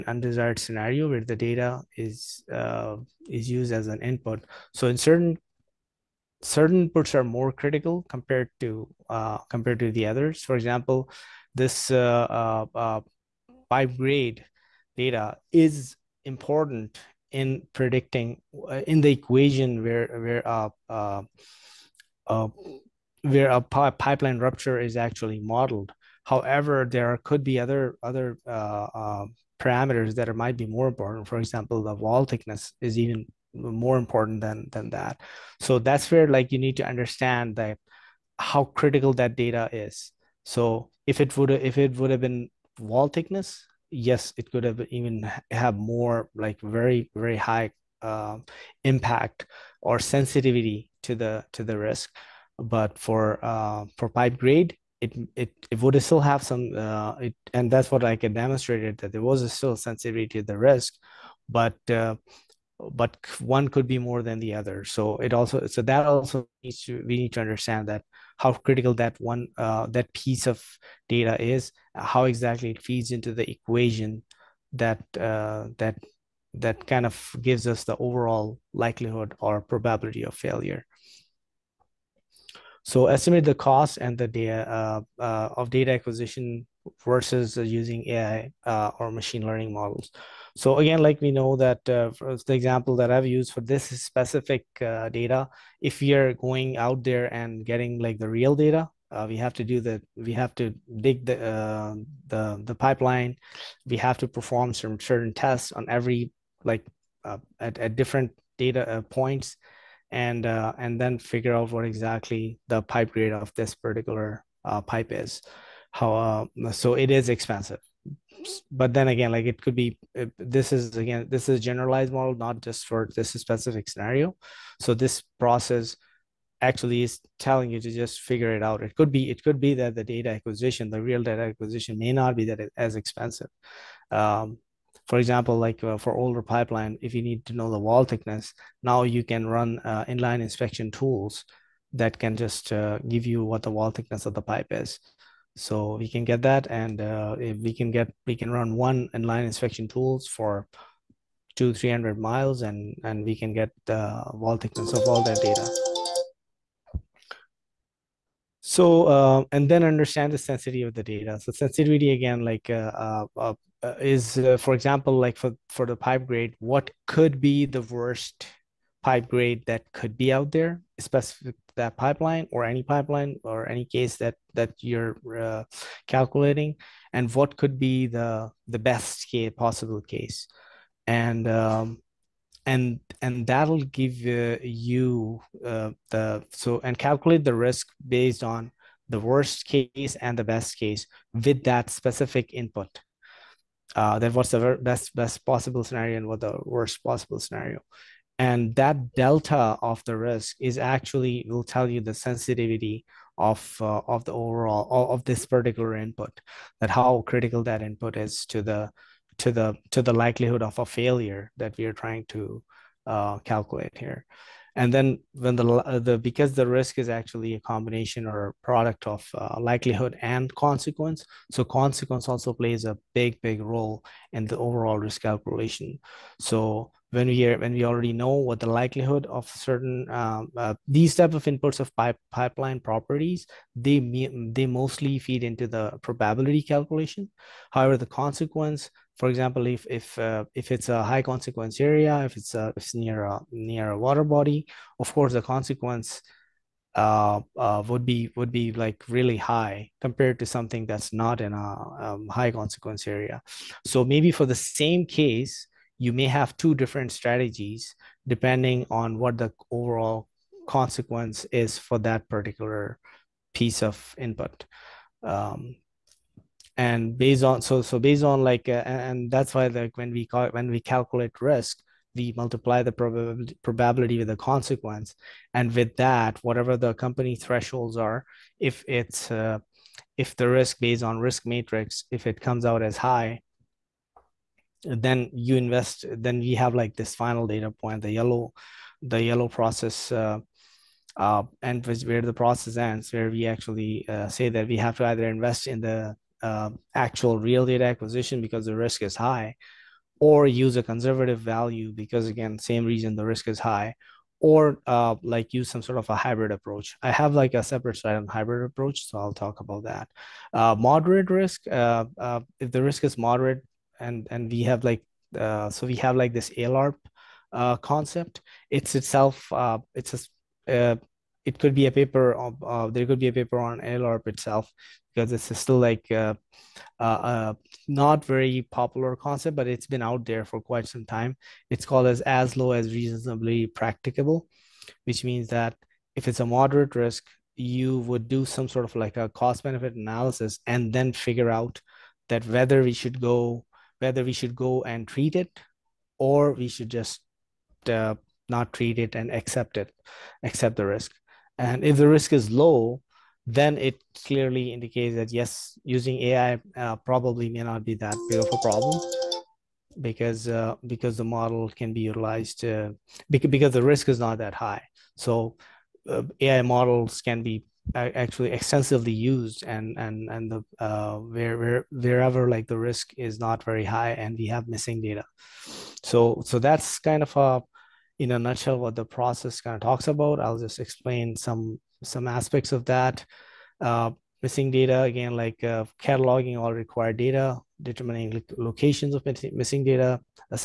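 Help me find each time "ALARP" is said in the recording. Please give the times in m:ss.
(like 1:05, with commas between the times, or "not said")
5:16, 5:23.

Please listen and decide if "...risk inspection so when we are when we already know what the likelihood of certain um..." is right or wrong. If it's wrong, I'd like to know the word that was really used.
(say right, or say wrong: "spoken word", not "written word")
wrong: "calculation", not "inspection".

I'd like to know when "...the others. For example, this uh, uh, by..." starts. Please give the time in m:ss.
0:09.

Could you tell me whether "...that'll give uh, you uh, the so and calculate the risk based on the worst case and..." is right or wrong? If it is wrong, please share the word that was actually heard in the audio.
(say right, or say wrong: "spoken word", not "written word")
right.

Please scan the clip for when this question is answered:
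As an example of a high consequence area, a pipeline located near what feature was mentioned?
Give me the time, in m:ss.
4:03.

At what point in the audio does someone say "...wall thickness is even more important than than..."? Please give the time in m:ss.
0:31.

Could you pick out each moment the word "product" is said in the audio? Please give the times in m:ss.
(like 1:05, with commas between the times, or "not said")
3:38.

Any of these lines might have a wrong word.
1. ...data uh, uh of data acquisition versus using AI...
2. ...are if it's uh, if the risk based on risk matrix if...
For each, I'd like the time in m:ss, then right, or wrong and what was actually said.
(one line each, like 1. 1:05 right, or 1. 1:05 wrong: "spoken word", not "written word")
1. 1:24 right
2. 4:37 right.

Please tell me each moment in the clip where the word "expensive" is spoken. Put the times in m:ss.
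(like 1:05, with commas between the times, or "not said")
1:57, 2:12.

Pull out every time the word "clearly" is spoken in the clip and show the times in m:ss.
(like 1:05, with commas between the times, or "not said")
5:54.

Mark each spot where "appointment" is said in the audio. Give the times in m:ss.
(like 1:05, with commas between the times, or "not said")
not said.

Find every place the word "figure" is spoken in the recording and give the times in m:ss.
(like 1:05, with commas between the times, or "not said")
1:51, 2:08, 5:41.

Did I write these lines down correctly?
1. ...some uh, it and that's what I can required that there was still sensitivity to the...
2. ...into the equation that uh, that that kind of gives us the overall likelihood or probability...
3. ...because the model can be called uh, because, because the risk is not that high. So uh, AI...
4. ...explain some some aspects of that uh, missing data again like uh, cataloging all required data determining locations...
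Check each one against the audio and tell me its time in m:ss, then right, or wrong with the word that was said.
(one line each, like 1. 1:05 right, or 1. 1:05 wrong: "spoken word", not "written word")
1. 0:56 wrong: "demonstrated", not "required"
2. 1:13 right
3. 6:00 wrong: "utilized", not "called"
4. 6:20 right.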